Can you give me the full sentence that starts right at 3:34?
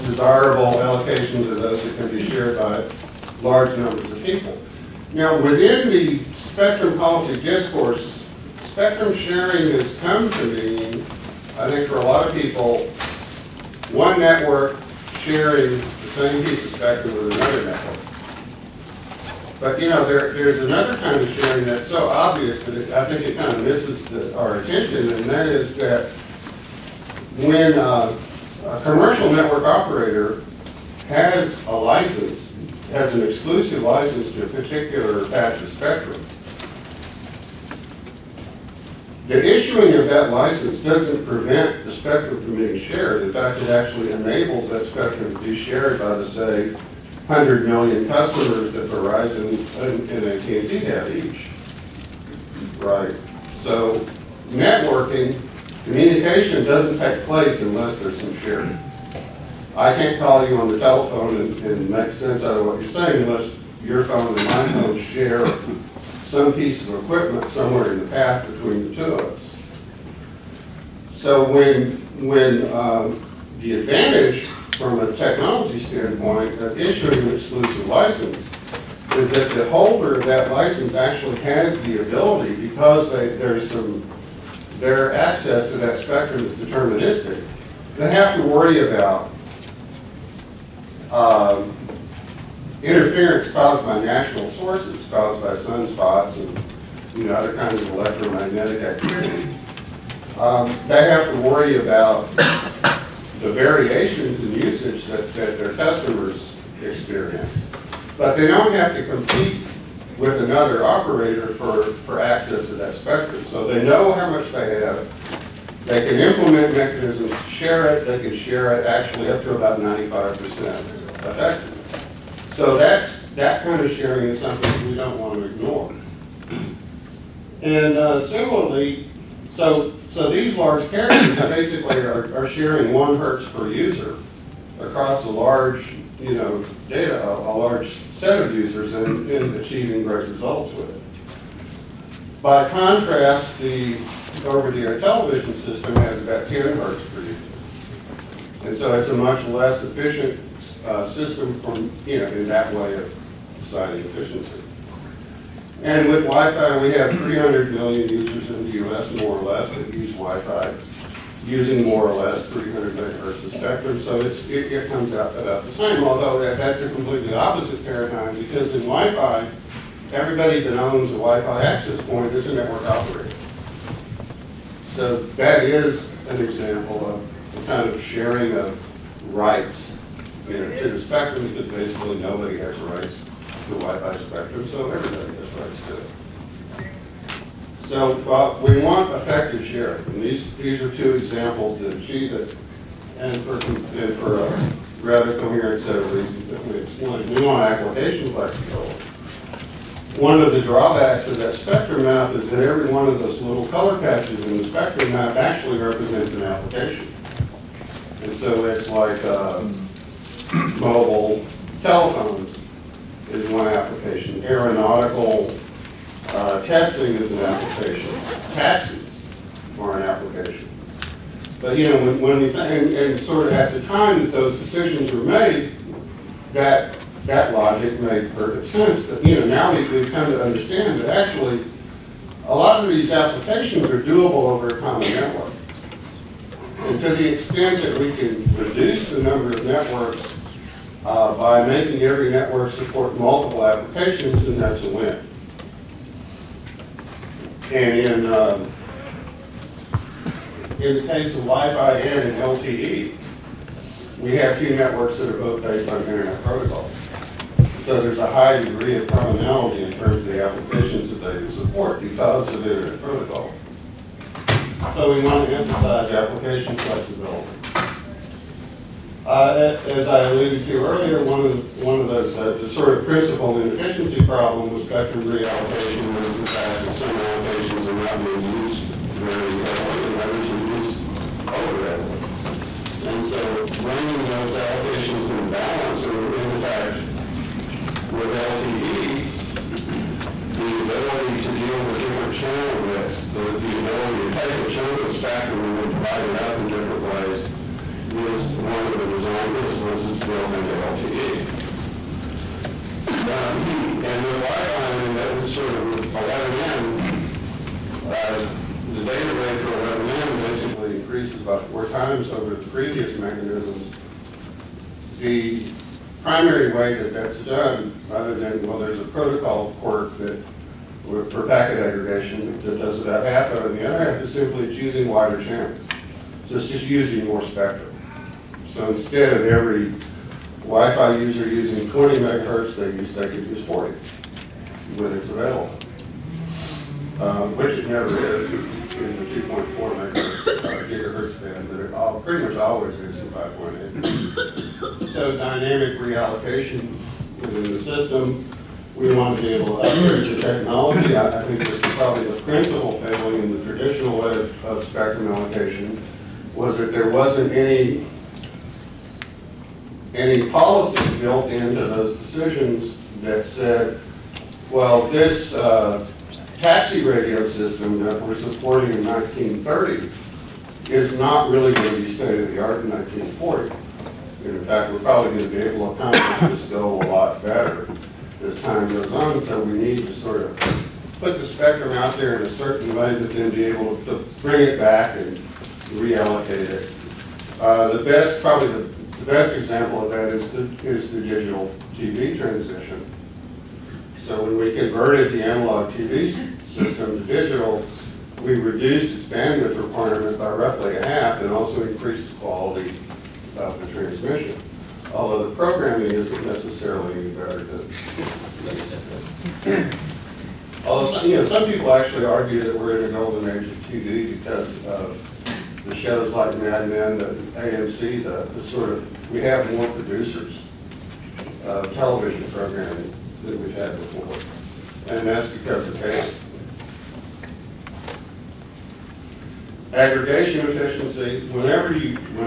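Aeronautical uh, testing is an application.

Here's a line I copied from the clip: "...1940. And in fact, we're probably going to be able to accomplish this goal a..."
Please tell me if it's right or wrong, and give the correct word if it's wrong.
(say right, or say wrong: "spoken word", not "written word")
right.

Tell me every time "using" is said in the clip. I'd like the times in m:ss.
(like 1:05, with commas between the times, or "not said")
2:41, 5:26, 5:31.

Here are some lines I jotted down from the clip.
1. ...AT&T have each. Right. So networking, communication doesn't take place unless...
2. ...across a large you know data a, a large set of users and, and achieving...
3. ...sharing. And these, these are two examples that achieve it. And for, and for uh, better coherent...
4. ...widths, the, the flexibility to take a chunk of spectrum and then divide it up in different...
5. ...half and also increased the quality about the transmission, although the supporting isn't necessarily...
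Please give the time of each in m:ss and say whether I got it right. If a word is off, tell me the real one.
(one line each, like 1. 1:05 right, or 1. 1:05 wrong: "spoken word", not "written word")
1. 0:50 right
2. 2:14 right
3. 3:09 wrong: "rather", not "better"
4. 4:52 wrong: "ability", not "flexibility"
5. 6:41 wrong: "programming", not "supporting".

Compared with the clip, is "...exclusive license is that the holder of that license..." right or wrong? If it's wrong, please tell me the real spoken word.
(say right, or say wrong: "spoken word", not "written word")
right.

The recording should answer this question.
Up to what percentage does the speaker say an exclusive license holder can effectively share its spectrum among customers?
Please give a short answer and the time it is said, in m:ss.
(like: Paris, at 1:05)
95%, at 1:59.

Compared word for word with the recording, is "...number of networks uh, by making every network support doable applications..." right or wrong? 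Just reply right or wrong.
wrong.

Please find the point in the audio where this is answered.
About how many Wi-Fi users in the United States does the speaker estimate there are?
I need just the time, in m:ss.
2:37.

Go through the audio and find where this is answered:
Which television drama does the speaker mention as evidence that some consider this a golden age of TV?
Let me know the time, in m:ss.
6:56.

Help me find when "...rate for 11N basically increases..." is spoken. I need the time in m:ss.
5:09.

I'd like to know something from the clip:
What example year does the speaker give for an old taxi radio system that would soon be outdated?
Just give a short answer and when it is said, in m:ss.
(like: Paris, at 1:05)
1930, at 6:09.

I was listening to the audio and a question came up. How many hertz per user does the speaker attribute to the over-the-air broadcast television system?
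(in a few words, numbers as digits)
10 hertz.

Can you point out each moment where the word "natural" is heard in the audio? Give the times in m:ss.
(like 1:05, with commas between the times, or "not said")
1:34.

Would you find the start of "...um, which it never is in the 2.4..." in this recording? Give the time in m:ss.
5:37.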